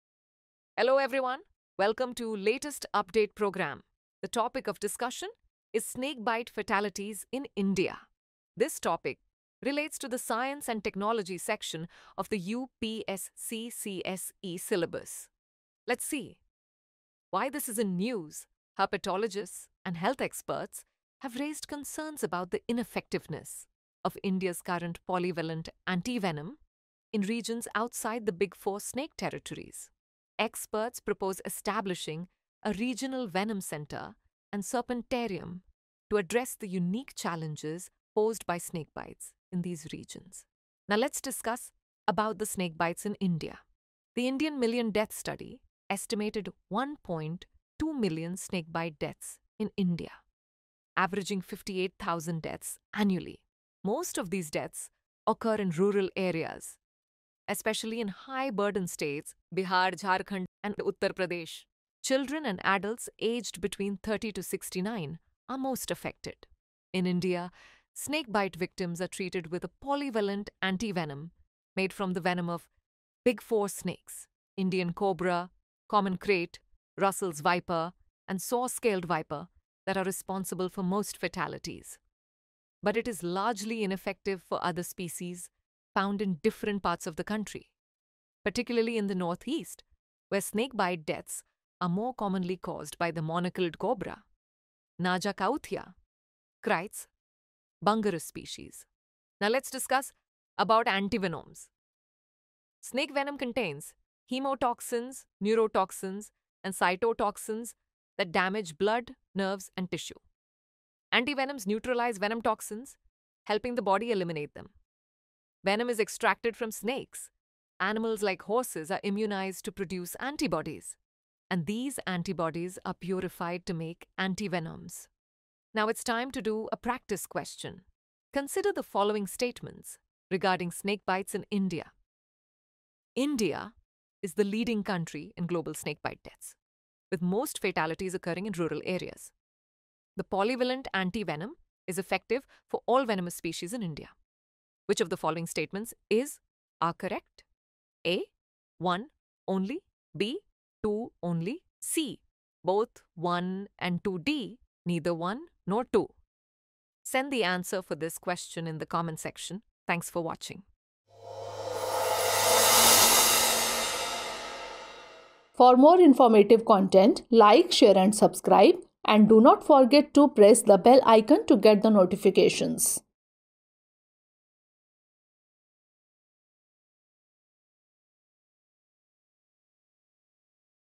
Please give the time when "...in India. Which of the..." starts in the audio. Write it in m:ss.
2:23.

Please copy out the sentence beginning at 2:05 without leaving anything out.
Now it's time to do a practice question.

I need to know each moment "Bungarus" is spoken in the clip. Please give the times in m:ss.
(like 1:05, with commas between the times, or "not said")
1:37.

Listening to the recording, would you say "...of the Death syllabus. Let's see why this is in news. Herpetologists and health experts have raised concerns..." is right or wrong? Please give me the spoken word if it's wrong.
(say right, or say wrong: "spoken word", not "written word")
wrong: "UPSCCSE", not "Death".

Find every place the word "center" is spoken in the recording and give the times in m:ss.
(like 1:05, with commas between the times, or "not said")
0:33.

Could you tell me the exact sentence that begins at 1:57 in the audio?
Animals like horses are immunized to produce antibodies.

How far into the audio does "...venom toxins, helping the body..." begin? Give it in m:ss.
1:52.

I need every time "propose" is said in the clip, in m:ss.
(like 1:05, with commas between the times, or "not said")
0:30.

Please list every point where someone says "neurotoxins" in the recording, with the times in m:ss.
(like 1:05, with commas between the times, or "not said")
1:45.